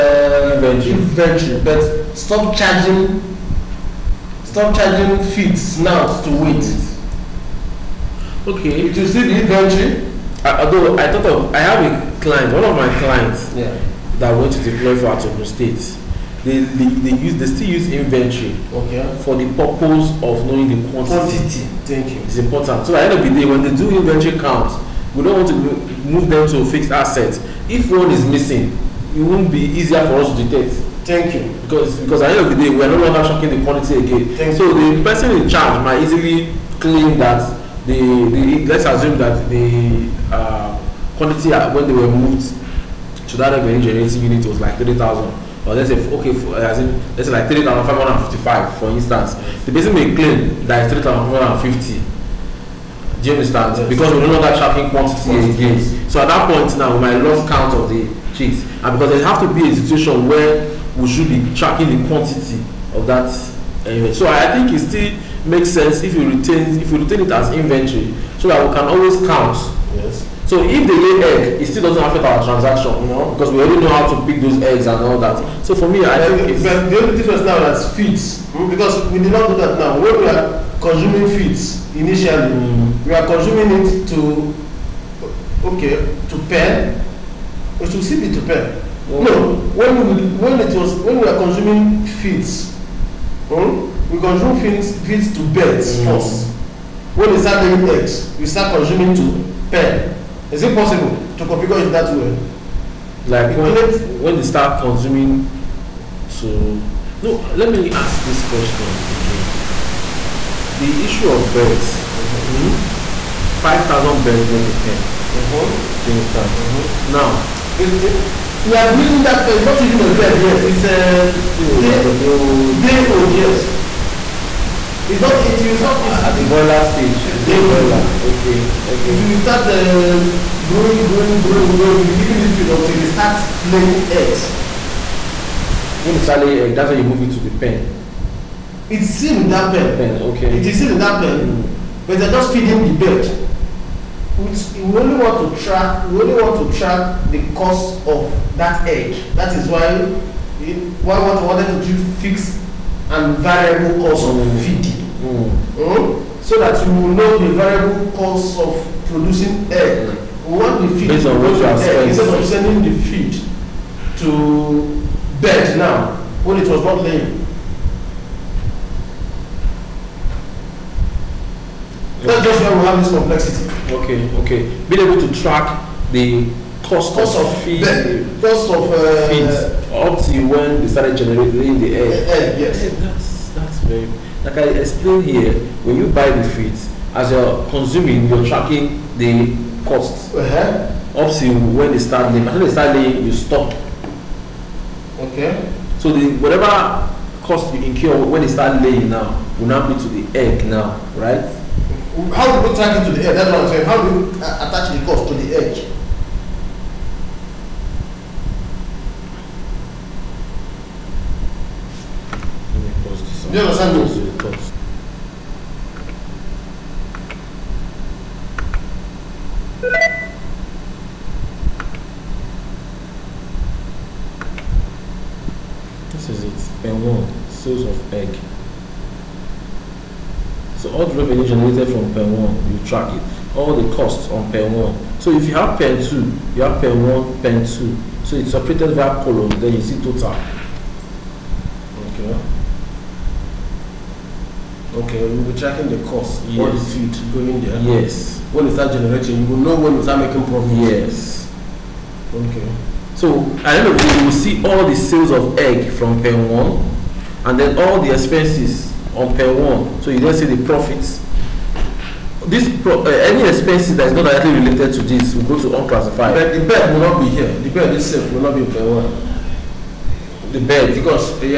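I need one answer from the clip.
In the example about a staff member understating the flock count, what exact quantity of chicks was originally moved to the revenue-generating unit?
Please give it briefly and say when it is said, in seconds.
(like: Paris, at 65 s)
30,555, at 47 s.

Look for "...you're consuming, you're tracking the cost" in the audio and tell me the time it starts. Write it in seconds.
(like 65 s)
187 s.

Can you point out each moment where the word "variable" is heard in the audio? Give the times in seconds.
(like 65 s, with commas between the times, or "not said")
153 s, 157 s.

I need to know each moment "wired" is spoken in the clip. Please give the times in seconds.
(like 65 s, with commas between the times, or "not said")
not said.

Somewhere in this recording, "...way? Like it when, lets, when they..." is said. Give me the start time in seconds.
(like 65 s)
102 s.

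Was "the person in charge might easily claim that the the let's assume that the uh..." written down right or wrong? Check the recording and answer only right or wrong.
right.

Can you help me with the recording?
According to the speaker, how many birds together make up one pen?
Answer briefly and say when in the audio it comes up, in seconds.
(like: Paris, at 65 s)
5,000, at 113 s.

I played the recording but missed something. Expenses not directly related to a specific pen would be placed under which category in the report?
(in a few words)
unclassified.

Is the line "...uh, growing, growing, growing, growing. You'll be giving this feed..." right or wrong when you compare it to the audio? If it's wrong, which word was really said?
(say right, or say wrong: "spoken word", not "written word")
right.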